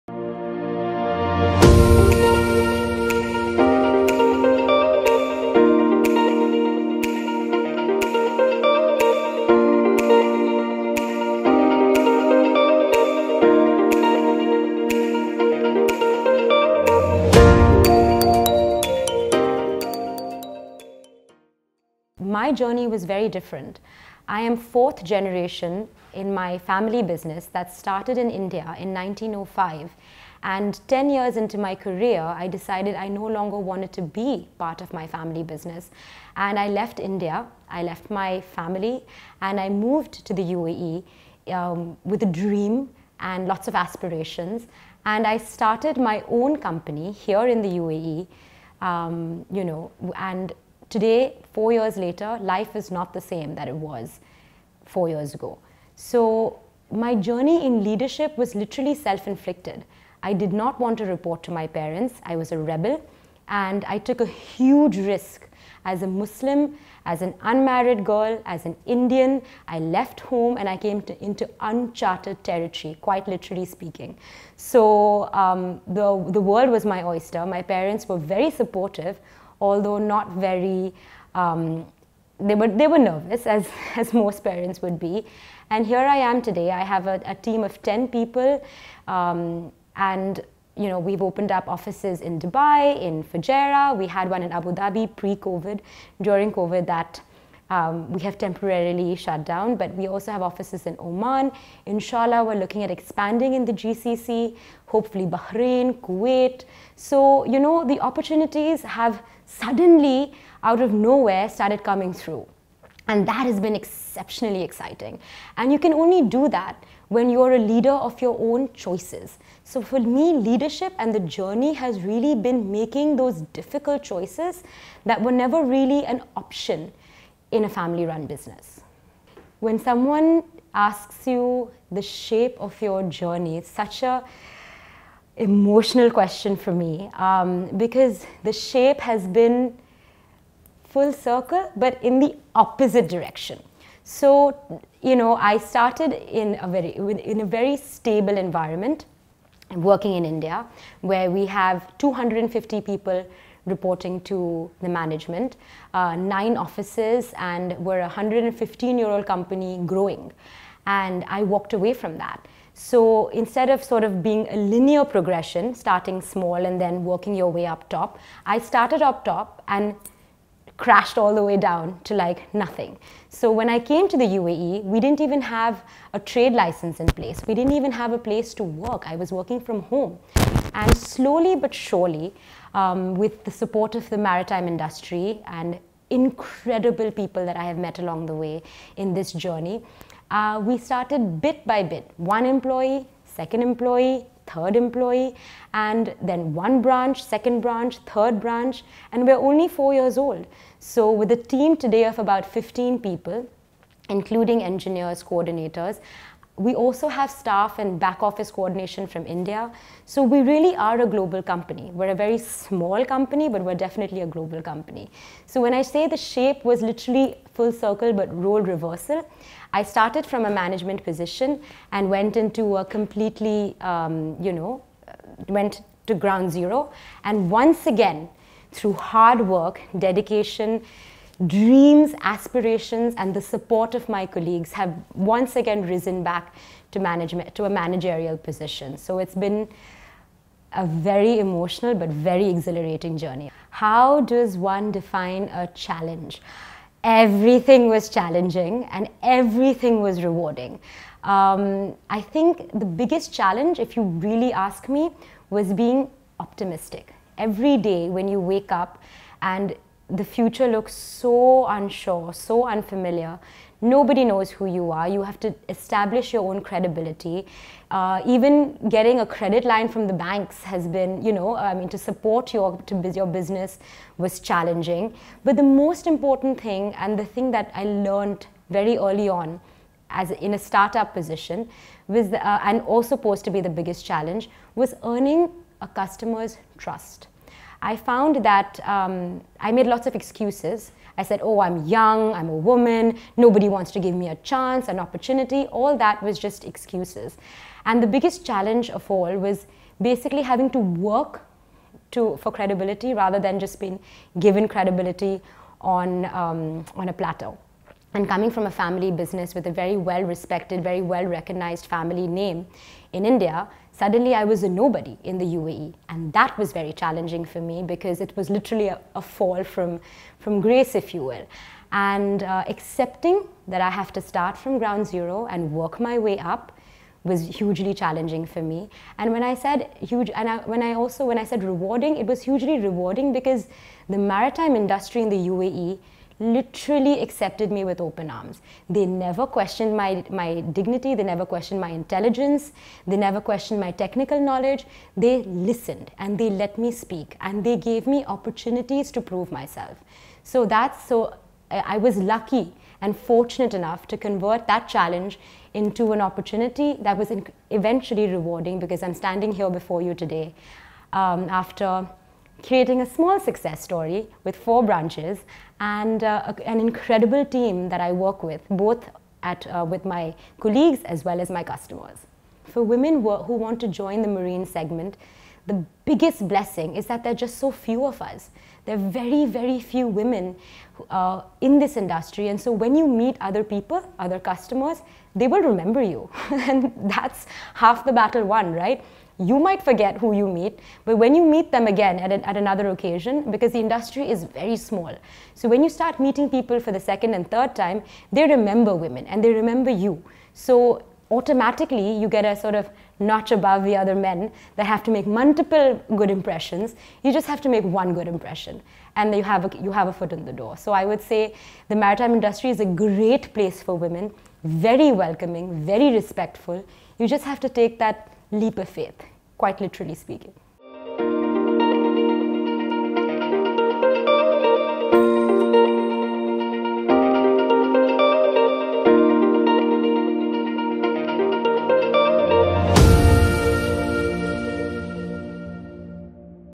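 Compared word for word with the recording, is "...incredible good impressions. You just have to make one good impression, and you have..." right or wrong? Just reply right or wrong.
wrong.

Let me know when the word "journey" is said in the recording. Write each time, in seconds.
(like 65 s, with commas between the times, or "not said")
22 s, 57 s, 121 s, 133 s, 189 s, 243 s.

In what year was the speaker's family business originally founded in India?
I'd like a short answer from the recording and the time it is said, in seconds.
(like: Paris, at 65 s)
1905, at 28 s.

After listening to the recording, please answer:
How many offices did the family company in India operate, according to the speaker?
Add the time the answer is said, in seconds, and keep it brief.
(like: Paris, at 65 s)
9, at 156 s.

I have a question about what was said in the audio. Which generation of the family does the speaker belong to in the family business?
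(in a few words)
Fourth.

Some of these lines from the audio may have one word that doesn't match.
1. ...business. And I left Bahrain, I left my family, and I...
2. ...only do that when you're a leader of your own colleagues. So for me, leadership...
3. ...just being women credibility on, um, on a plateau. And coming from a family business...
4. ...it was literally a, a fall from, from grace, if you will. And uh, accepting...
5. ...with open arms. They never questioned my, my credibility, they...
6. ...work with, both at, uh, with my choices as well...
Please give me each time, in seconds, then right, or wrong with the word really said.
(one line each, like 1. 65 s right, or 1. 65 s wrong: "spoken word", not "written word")
1. 35 s wrong: "India", not "Bahrain"
2. 115 s wrong: "choices", not "colleagues"
3. 303 s wrong: "given", not "women"
4. 318 s right
5. 337 s wrong: "dignity", not "credibility"
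6. 368 s wrong: "colleagues", not "choices".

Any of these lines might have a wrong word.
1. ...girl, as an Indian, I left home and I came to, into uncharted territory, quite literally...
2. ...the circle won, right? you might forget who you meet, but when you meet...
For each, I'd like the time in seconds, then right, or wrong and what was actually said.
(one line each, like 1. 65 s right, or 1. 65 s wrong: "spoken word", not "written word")
1. 68 s right
2. 388 s wrong: "battle", not "circle".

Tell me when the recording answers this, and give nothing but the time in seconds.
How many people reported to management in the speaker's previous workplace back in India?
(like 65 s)
152 s.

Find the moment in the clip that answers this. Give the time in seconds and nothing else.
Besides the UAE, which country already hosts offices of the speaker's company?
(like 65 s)
100 s.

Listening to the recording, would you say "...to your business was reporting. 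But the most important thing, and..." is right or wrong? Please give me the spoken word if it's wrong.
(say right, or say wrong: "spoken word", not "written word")
wrong: "challenging", not "reporting".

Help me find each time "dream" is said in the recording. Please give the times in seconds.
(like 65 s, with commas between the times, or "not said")
42 s, 231 s.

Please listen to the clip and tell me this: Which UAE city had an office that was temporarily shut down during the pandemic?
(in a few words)
Abu Dhabi.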